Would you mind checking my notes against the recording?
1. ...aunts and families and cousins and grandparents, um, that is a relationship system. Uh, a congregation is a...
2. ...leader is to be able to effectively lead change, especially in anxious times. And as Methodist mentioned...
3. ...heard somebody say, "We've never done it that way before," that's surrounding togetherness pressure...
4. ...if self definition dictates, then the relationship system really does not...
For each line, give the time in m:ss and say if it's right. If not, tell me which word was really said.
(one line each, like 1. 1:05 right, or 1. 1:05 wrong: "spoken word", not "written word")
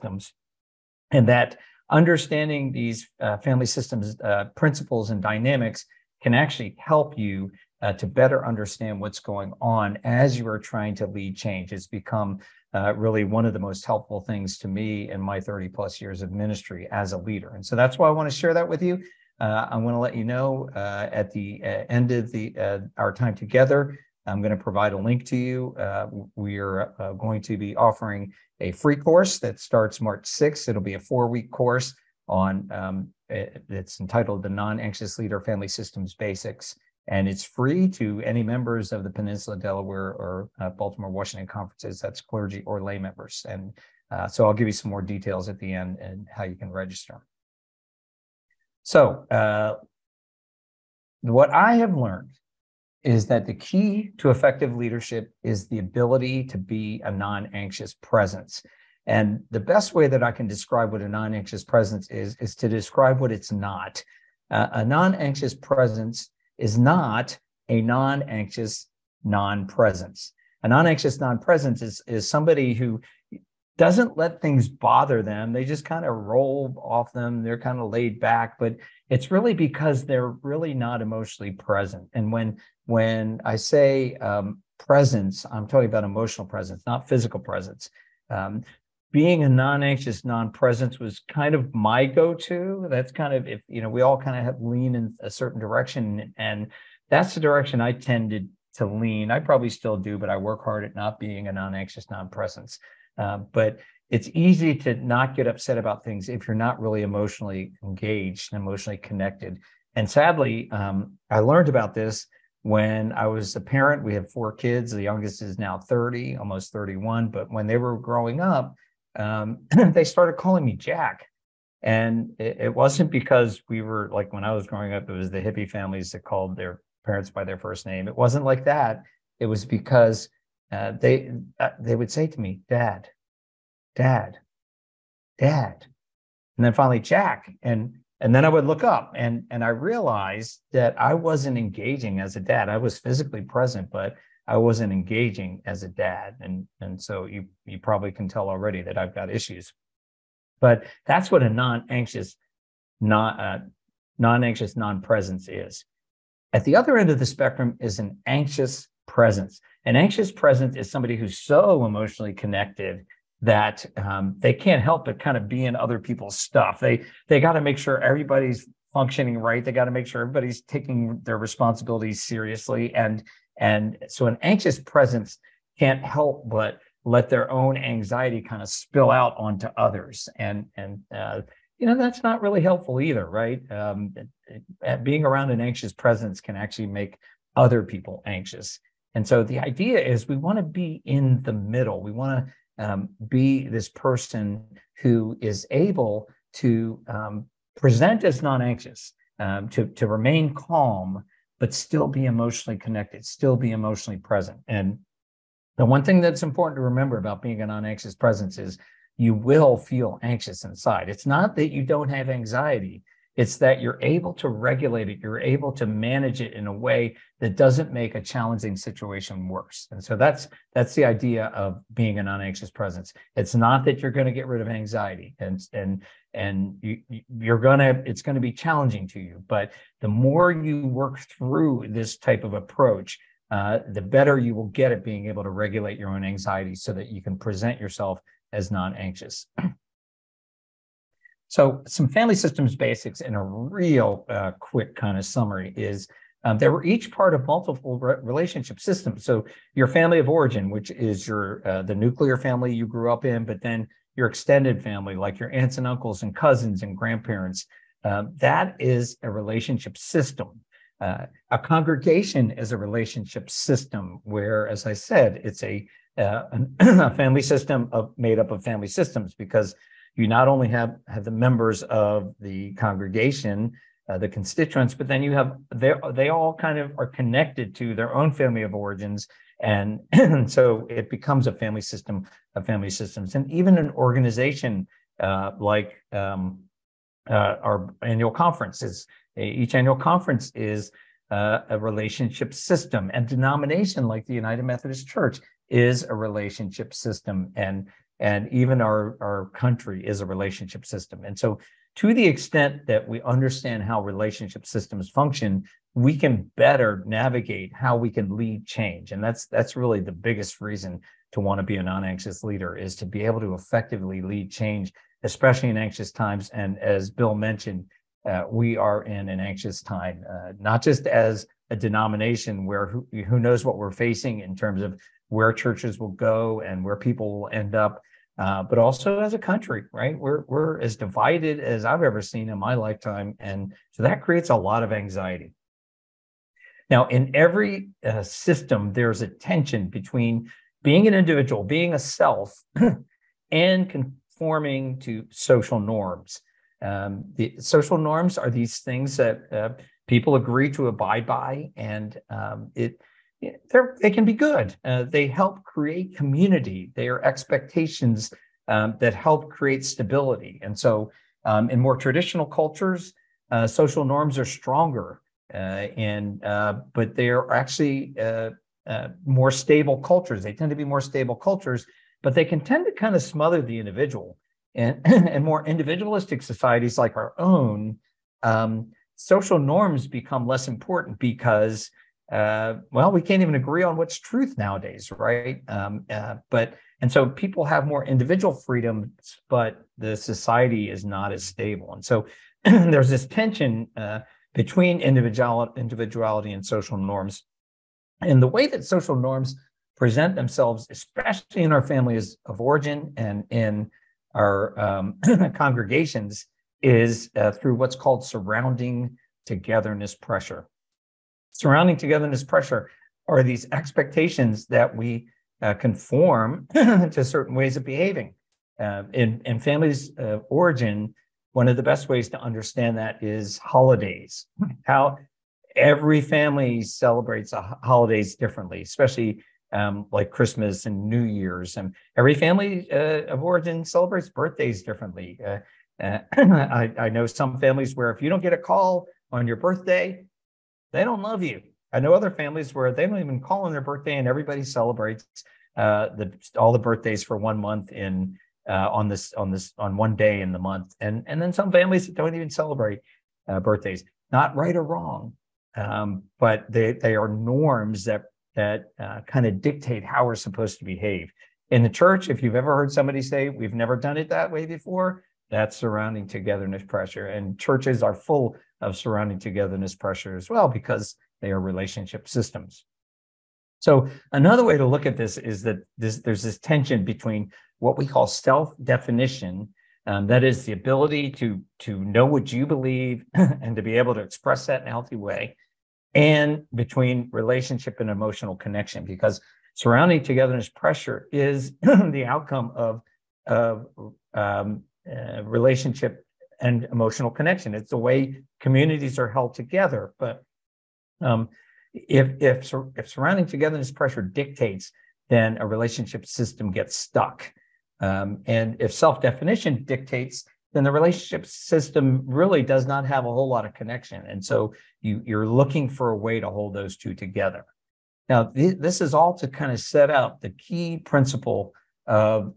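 1. 4:15 wrong: "uncles", not "families"
2. 5:12 wrong: "Bill", not "Methodist"
3. 7:42 right
4. 8:28 right.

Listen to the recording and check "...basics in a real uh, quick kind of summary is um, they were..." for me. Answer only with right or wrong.
right.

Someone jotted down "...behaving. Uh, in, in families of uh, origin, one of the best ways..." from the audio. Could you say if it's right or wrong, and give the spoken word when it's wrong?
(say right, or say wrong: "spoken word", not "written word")
right.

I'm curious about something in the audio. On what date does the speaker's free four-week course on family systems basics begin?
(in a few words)
March 6th.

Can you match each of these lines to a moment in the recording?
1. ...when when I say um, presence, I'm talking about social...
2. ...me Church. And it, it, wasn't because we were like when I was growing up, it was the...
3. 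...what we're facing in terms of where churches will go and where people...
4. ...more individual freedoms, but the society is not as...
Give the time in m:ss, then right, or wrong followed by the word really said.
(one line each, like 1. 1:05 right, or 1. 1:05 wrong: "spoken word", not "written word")
1. 1:22 wrong: "emotional", not "social"
2. 2:00 wrong: "Jack", not "Church"
3. 5:23 right
4. 6:27 right.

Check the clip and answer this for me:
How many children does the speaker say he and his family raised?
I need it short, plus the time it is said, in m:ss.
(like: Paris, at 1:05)
4, at 1:54.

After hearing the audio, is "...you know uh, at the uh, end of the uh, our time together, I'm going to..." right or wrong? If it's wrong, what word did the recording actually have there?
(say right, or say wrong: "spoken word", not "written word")
right.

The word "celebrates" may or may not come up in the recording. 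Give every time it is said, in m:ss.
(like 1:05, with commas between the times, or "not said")
7:06, 7:13, 7:24, 7:32.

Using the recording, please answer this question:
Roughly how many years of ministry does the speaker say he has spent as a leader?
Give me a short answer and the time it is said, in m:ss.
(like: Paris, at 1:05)
30 plus, at 0:15.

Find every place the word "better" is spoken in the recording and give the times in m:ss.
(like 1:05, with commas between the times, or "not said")
0:08, 3:54, 5:06.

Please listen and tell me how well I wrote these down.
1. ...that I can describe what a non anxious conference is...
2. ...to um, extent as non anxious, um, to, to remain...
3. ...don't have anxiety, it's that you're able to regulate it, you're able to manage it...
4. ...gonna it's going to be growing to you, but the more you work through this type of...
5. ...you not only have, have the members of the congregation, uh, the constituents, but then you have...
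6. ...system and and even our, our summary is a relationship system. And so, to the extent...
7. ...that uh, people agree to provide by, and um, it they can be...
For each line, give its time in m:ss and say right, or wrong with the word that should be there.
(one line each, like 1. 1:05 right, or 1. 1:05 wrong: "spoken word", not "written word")
1. 1:00 wrong: "presence", not "conference"
2. 3:16 wrong: "present", not "extent"
3. 3:31 right
4. 3:47 wrong: "challenging", not "growing"
5. 4:30 right
6. 4:57 wrong: "country", not "summary"
7. 5:49 wrong: "abide", not "provide".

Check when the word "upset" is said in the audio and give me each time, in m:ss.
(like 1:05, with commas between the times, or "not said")
1:45.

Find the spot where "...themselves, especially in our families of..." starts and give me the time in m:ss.
6:40.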